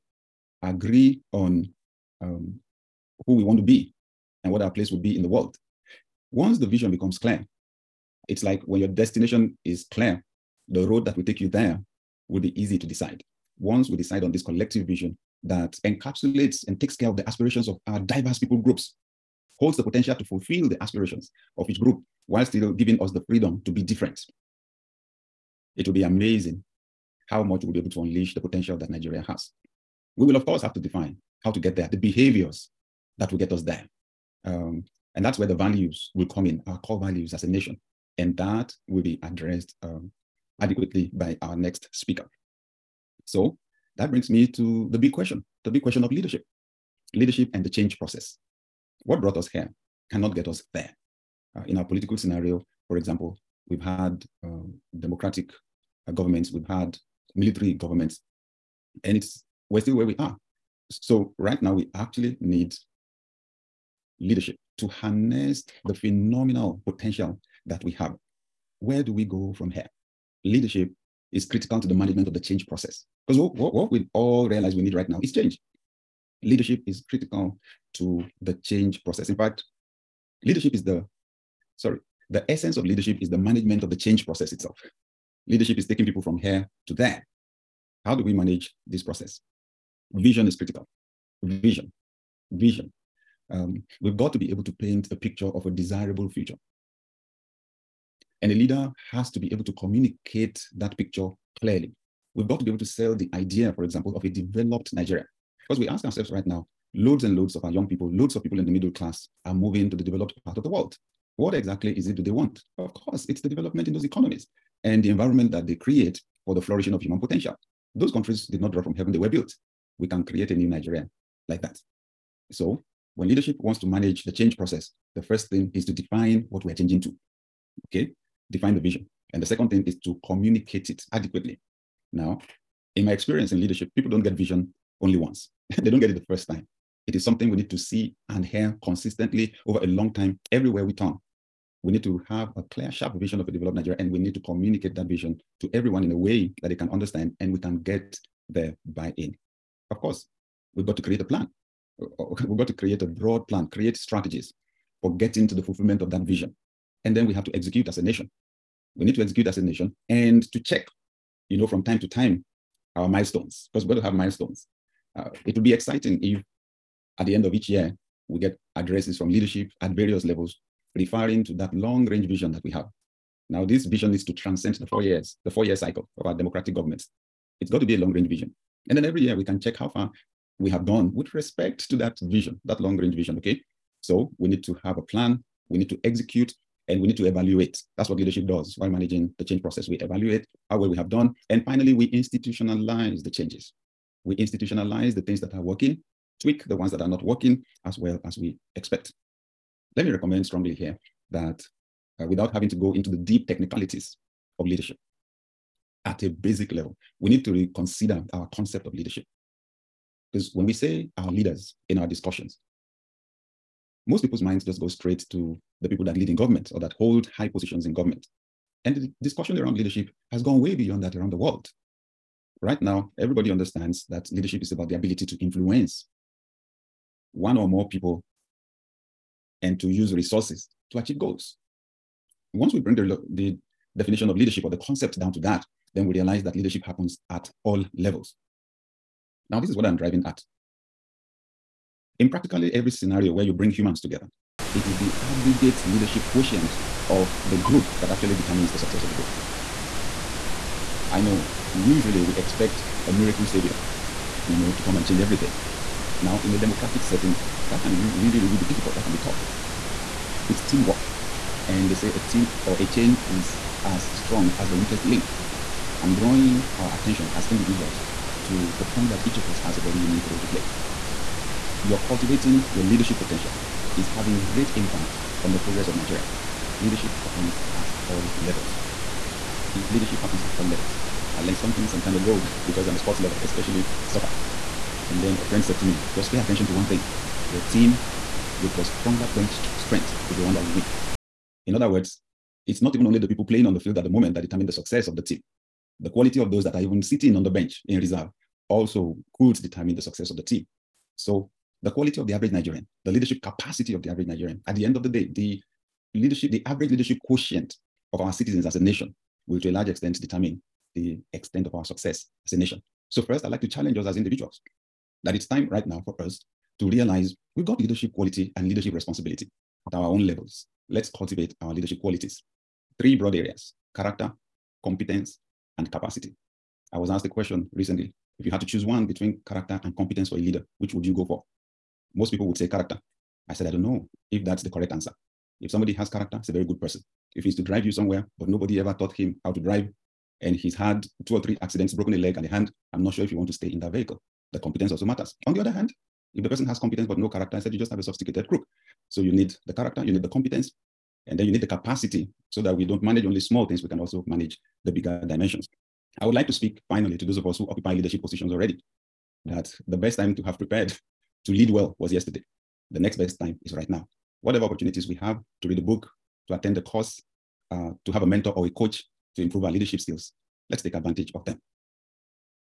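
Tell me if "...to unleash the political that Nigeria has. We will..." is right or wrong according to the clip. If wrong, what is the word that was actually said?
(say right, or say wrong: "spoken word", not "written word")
wrong: "potential", not "political".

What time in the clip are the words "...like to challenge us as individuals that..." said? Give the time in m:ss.
5:13.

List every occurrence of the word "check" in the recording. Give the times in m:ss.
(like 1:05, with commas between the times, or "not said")
2:40, 2:59.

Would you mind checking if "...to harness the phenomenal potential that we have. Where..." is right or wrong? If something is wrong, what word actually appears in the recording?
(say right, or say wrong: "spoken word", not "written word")
right.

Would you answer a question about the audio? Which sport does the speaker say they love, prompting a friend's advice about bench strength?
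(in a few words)
soccer.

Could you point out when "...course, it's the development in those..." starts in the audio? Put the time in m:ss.
1:52.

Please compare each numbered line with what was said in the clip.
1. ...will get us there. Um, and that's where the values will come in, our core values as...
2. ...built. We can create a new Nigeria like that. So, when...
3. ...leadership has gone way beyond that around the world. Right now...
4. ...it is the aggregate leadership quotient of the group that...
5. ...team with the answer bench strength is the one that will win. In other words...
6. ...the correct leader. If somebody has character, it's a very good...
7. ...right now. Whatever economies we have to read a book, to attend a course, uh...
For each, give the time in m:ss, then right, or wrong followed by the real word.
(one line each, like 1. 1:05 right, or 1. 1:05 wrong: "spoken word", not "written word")
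1. 0:33 right
2. 1:59 right
3. 3:39 right
4. 4:04 right
5. 4:47 wrong: "stronger", not "answer"
6. 5:34 wrong: "answer", not "leader"
7. 6:03 wrong: "opportunities", not "economies".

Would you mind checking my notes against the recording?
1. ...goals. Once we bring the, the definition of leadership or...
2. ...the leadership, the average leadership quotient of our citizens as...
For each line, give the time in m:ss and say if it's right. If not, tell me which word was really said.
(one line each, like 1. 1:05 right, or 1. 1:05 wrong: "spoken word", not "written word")
1. 3:51 right
2. 5:05 right.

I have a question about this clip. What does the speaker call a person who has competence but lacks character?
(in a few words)
a sophisticated crook.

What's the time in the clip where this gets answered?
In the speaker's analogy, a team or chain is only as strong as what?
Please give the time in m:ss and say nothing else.
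4:24.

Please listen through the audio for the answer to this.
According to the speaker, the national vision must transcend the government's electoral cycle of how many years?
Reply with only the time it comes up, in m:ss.
2:55.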